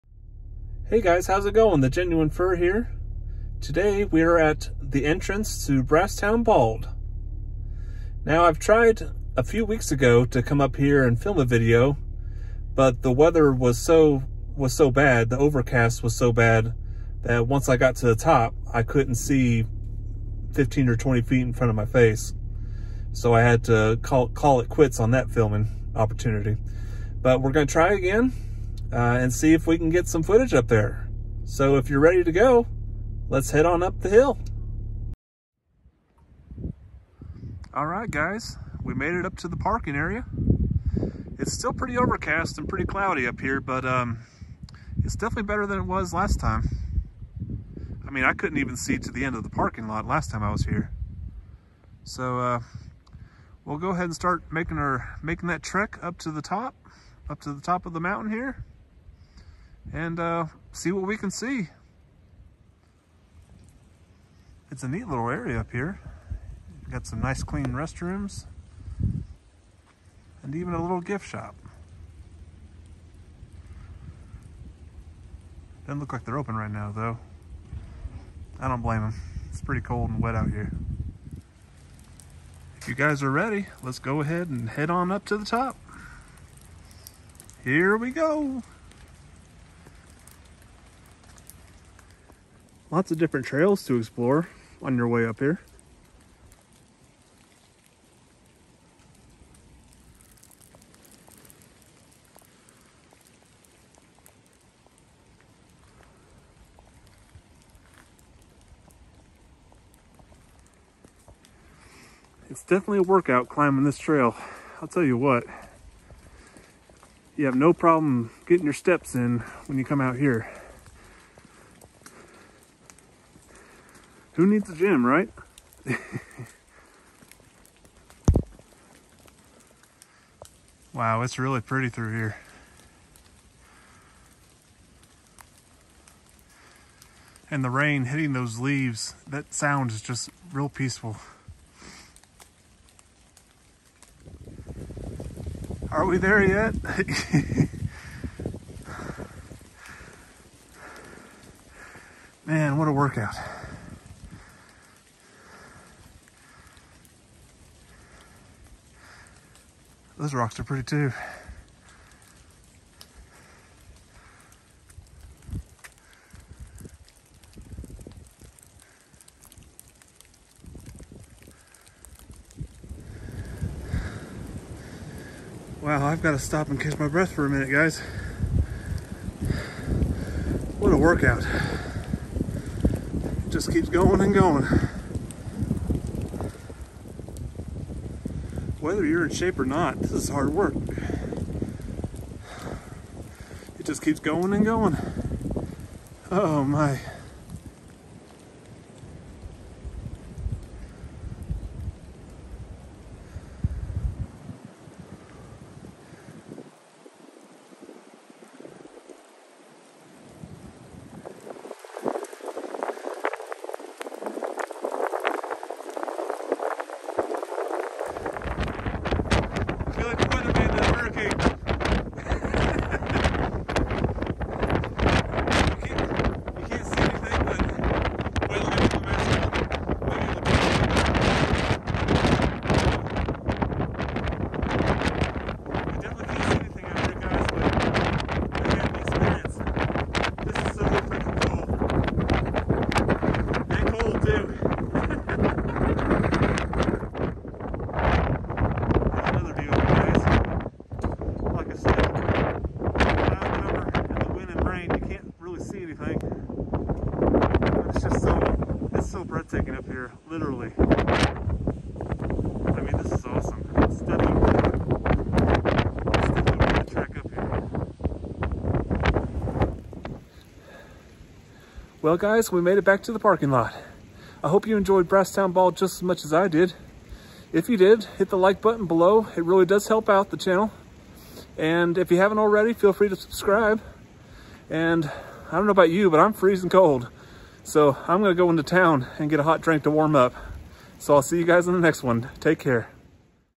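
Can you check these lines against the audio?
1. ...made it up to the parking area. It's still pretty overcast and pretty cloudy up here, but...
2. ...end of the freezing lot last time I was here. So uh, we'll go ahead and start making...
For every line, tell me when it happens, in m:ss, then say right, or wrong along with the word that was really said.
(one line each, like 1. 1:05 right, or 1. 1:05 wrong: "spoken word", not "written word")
1. 0:38 right
2. 0:49 wrong: "parking", not "freezing".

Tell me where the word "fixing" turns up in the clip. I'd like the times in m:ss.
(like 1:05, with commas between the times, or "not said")
not said.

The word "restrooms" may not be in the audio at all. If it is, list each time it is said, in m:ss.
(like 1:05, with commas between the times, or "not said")
1:07.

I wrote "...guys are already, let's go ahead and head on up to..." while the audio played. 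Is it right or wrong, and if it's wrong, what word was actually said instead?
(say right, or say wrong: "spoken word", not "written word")
wrong: "ready", not "already".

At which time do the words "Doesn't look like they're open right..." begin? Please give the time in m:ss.
1:15.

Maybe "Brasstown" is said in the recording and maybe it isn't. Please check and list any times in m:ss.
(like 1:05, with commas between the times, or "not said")
0:05, 4:35.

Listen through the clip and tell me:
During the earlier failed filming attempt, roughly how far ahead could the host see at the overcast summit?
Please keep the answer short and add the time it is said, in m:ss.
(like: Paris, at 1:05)
15 or 20 feet, at 0:20.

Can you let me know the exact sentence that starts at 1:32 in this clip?
Lots of different trails to explore on your way up here.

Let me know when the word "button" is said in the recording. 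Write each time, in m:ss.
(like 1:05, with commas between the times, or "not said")
4:38.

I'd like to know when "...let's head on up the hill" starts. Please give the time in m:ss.
0:33.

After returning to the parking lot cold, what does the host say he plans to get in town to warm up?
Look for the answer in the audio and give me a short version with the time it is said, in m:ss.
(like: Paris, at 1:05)
A hot drink, at 4:49.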